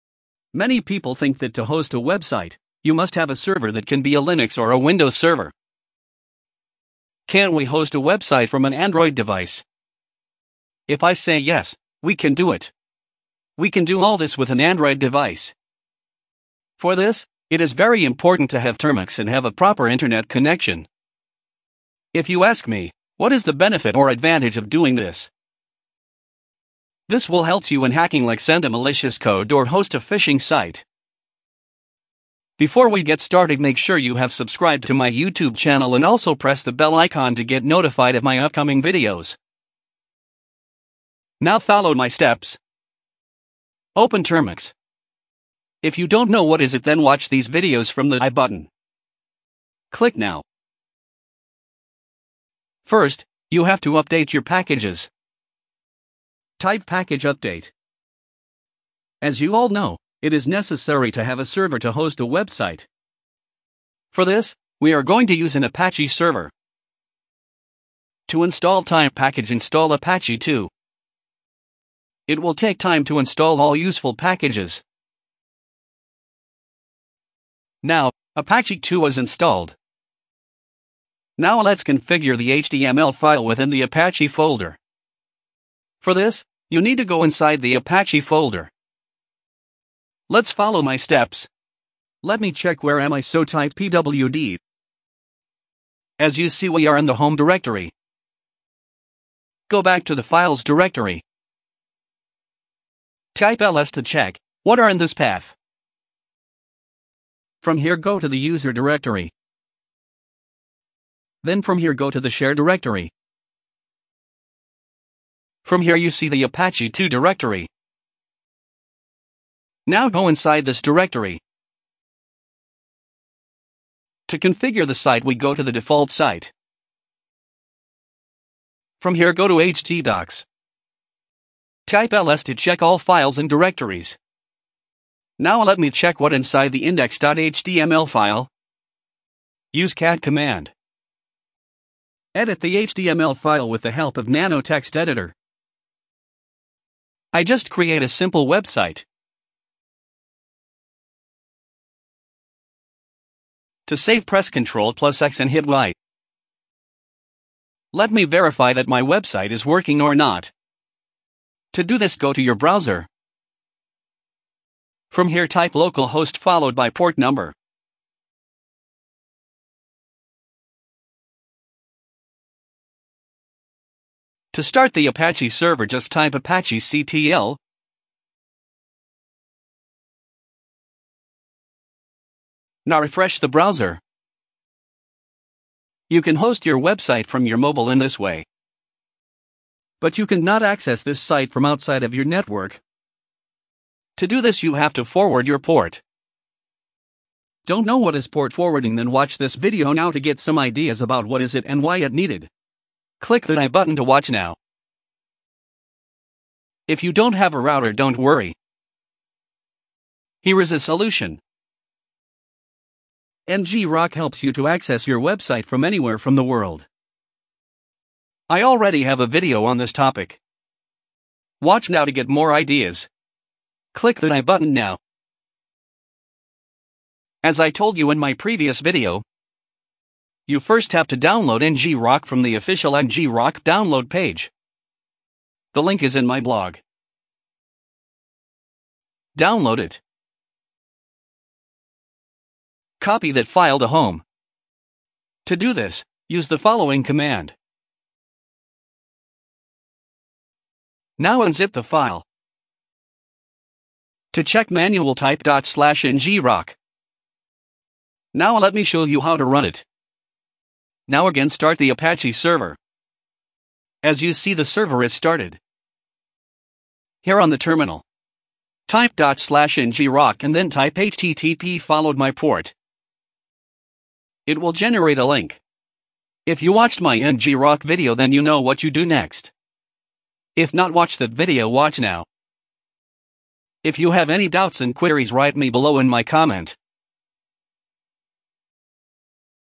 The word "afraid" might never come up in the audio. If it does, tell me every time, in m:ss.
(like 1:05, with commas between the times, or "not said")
not said.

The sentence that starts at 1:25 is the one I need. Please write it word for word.
For this, you need to go inside the Apache folder.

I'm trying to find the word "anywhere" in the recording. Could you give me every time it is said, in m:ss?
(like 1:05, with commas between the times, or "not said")
3:35.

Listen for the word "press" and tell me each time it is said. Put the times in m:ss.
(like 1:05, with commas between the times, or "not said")
0:36, 2:34.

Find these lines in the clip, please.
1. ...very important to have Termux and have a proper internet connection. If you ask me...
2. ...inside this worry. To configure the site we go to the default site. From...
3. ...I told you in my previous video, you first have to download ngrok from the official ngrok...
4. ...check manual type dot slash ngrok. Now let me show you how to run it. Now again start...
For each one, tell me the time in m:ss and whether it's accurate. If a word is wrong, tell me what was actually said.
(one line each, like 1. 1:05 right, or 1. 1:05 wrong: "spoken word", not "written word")
1. 0:17 right
2. 2:00 wrong: "directory", not "worry"
3. 3:47 right
4. 4:14 right.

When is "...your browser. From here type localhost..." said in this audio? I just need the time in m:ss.
2:42.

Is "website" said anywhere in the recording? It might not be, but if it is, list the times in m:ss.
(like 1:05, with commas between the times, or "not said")
0:01, 0:08, 1:02, 2:28, 2:39, 3:06, 3:35.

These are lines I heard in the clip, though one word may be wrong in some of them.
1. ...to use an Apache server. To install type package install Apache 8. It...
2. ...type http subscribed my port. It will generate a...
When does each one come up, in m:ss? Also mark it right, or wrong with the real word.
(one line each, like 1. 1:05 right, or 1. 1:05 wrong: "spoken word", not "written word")
1. 1:05 wrong: "2", not "8"
2. 4:30 wrong: "followed", not "subscribed".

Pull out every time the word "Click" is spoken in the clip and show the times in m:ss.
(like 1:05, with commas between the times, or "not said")
0:49, 3:23, 3:43.